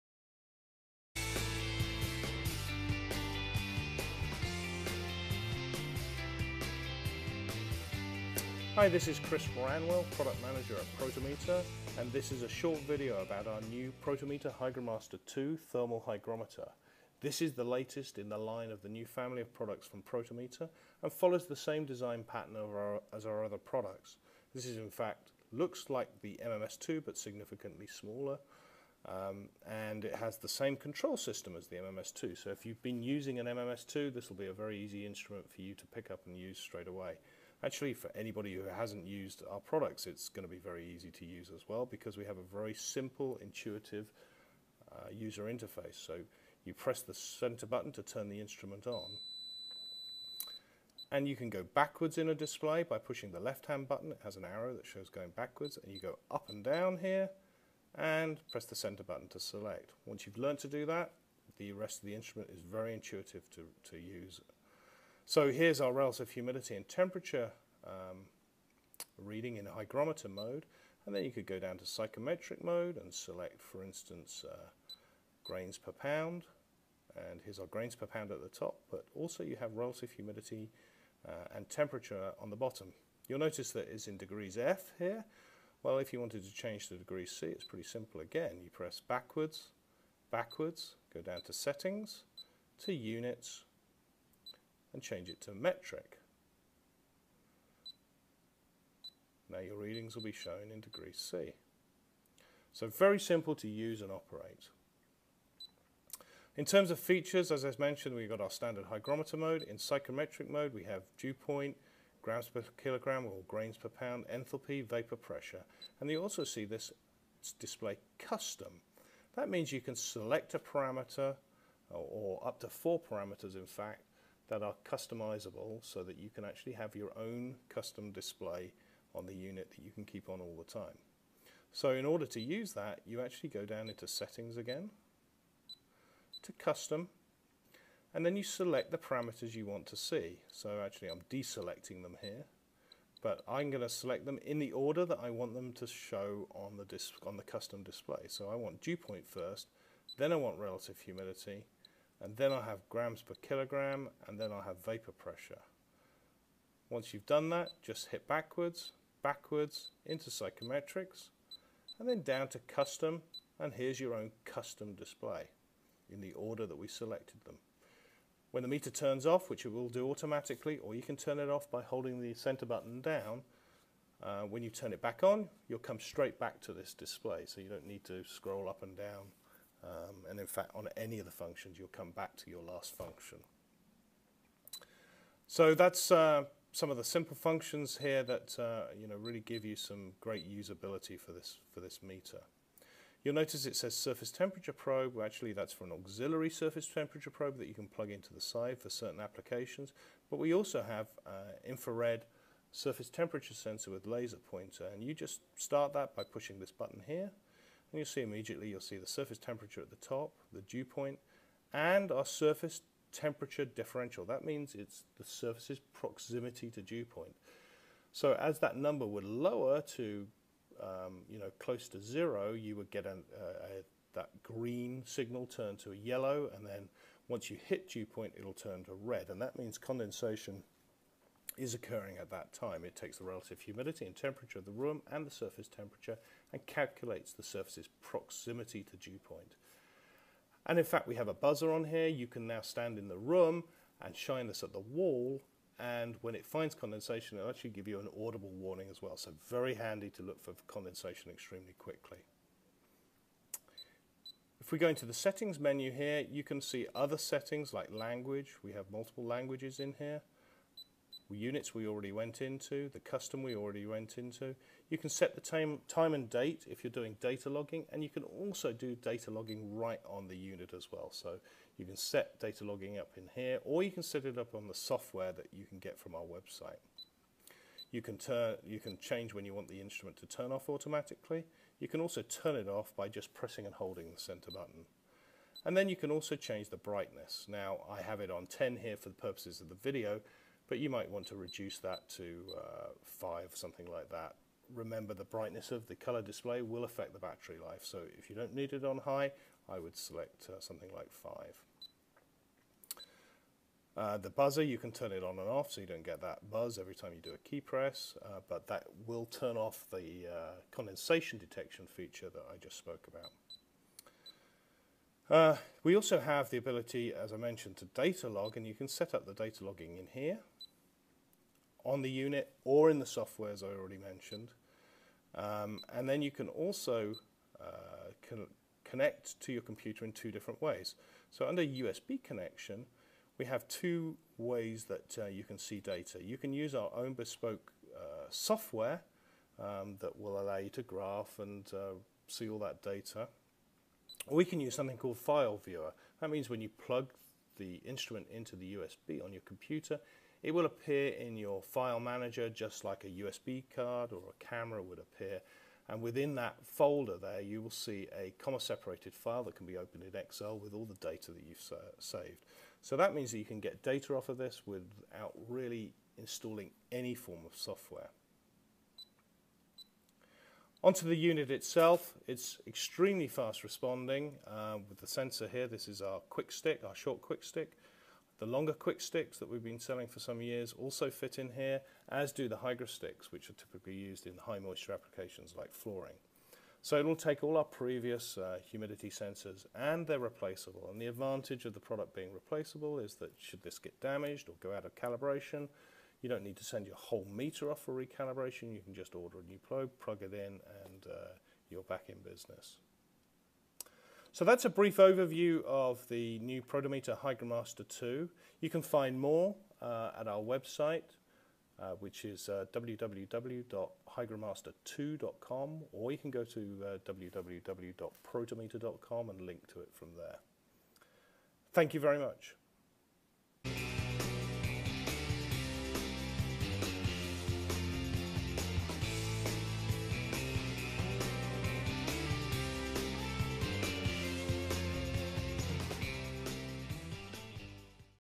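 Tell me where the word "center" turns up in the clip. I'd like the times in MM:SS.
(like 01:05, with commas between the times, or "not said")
00:47, 00:58, 02:52, 04:44.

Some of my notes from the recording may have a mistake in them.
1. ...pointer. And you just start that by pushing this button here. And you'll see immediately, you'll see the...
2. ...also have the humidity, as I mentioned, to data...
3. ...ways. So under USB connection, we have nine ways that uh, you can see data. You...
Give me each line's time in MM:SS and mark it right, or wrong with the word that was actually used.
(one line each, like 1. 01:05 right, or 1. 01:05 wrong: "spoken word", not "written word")
1. 03:24 right
2. 05:15 wrong: "ability", not "humidity"
3. 05:30 wrong: "two", not "nine".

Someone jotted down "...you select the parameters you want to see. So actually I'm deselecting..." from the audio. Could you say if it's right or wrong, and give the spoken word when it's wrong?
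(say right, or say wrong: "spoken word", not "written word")
right.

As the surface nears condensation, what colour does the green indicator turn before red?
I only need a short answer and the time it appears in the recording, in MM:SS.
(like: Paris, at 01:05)
yellow, at 03:45.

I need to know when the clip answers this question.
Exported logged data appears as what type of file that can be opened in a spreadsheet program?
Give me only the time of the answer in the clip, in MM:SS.
05:58.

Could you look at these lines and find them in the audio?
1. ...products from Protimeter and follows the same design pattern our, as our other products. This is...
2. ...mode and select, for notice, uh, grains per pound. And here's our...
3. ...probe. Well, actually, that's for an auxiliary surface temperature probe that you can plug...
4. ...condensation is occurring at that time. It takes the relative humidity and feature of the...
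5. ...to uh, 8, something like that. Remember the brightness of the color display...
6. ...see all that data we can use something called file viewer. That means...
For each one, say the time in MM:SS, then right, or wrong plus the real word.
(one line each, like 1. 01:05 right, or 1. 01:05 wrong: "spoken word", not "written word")
1. 00:19 right
2. 01:12 wrong: "instance", not "notice"
3. 03:14 right
4. 03:49 wrong: "temperature", not "feature"
5. 04:52 wrong: "5", not "8"
6. 05:42 right.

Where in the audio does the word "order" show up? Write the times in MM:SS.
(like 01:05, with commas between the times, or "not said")
02:12, 02:24, 02:46, 06:39.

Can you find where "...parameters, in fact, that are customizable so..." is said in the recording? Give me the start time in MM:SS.
02:03.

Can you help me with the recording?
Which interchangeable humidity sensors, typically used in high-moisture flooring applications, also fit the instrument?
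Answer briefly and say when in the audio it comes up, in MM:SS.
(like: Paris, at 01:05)
Hygrosticks, at 06:22.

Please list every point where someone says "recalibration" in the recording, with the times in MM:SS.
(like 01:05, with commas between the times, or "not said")
06:37.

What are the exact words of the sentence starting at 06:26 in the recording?
So it'll take all our previous uh, humidity sensors and they're replaceable.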